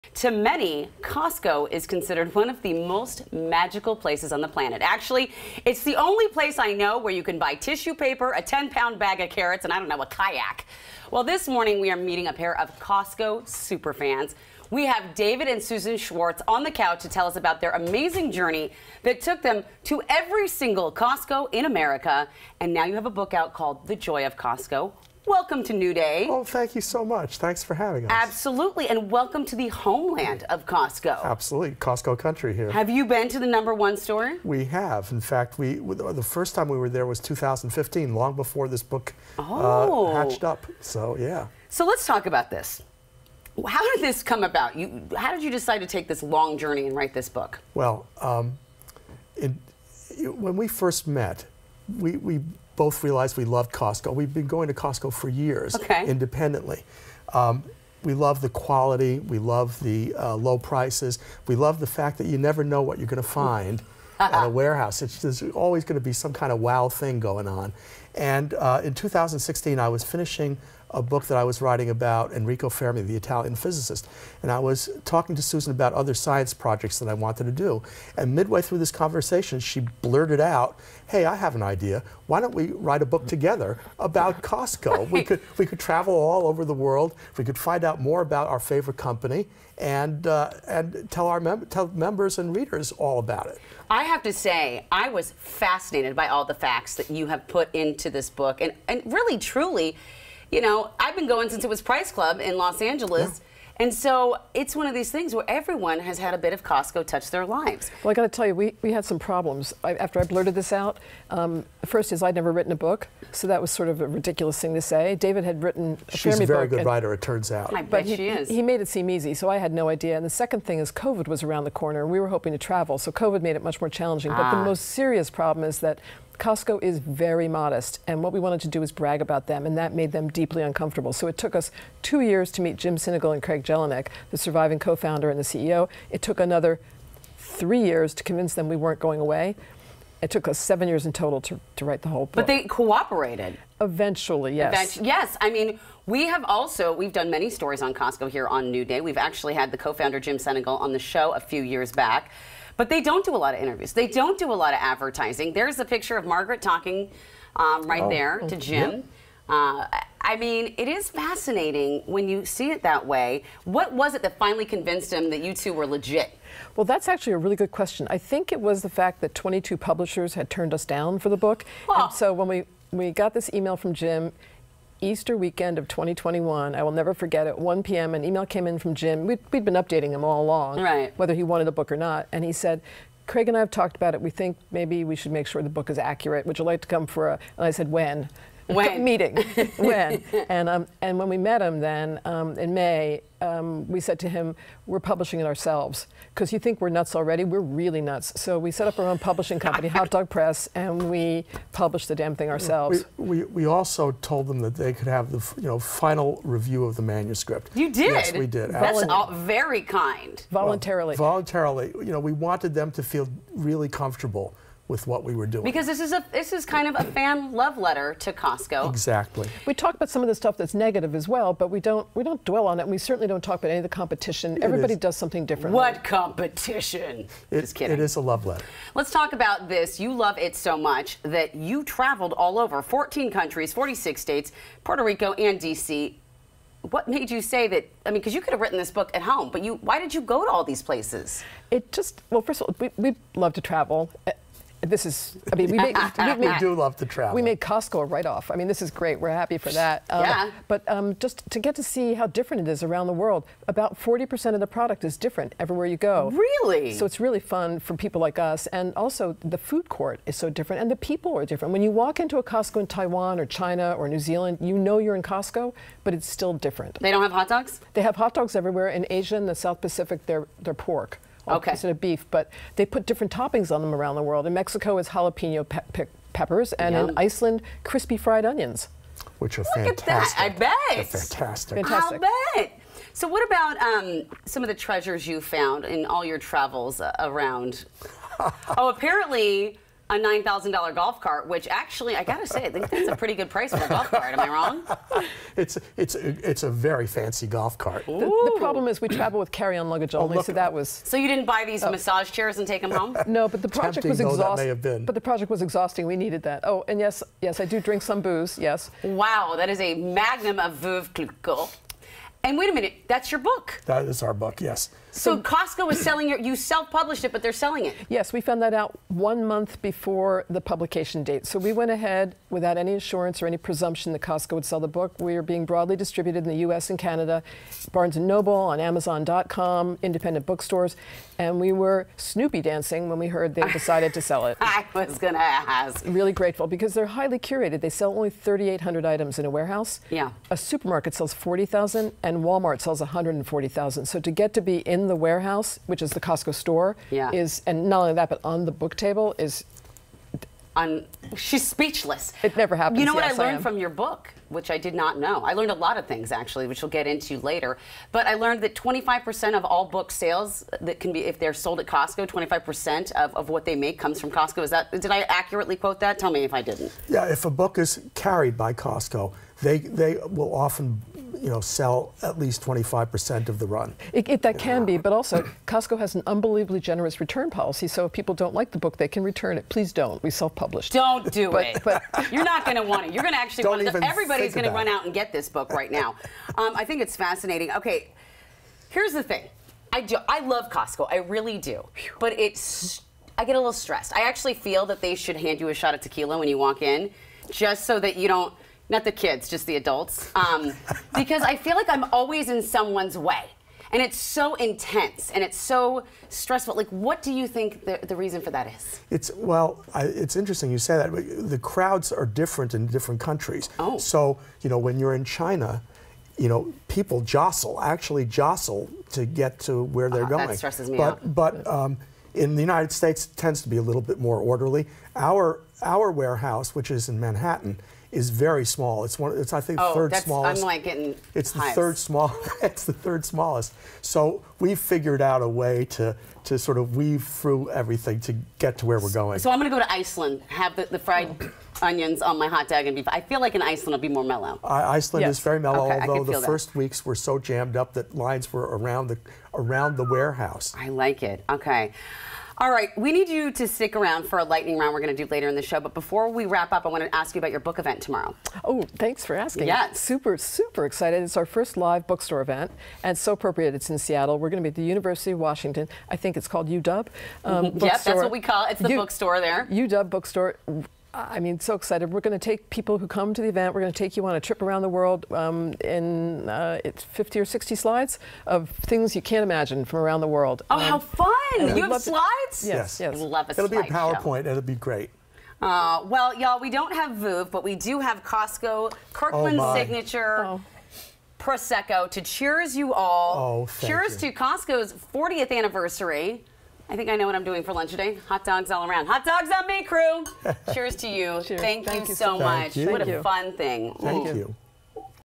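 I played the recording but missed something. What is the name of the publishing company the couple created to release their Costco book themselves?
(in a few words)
Hot Dog Press.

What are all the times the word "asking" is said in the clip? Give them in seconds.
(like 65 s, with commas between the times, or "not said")
459 s.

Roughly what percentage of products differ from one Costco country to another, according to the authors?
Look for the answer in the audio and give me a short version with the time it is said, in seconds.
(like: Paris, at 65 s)
40%, at 253 s.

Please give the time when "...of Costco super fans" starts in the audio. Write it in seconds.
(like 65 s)
12 s.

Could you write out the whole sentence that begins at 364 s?
Is that did I accurately quote that?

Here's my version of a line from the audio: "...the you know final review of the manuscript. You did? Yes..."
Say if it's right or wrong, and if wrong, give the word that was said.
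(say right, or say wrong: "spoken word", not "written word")
right.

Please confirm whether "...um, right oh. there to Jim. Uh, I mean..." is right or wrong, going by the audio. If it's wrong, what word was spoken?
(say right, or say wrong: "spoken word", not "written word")
right.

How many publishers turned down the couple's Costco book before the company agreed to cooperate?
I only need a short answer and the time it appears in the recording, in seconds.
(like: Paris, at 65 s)
22, at 169 s.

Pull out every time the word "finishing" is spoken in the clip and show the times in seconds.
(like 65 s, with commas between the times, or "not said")
70 s.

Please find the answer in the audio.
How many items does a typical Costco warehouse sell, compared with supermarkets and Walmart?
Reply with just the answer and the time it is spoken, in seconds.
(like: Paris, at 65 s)
3,800, at 338 s.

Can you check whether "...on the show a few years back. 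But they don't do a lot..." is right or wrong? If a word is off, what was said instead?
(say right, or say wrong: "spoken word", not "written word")
right.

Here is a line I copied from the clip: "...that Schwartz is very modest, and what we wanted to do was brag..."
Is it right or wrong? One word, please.
wrong.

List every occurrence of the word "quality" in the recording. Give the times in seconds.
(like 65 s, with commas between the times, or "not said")
58 s.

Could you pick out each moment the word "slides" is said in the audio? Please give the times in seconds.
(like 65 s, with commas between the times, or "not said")
477 s, 482 s.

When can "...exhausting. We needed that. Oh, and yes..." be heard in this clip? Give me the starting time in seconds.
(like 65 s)
305 s.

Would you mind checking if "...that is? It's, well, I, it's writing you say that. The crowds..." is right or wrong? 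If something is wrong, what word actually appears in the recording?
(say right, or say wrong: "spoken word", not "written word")
wrong: "interesting", not "writing".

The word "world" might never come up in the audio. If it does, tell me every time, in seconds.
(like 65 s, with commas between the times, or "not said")
86 s, 253 s, 274 s, 474 s, 480 s.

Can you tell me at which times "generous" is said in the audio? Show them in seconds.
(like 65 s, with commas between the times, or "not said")
376 s.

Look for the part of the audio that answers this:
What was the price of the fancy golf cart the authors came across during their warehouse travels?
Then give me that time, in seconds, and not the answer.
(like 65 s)
290 s.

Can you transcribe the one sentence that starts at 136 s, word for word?
It took another three years to convince them we weren't going away.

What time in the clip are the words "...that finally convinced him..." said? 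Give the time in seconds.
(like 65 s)
164 s.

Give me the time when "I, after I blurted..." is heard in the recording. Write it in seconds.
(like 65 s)
109 s.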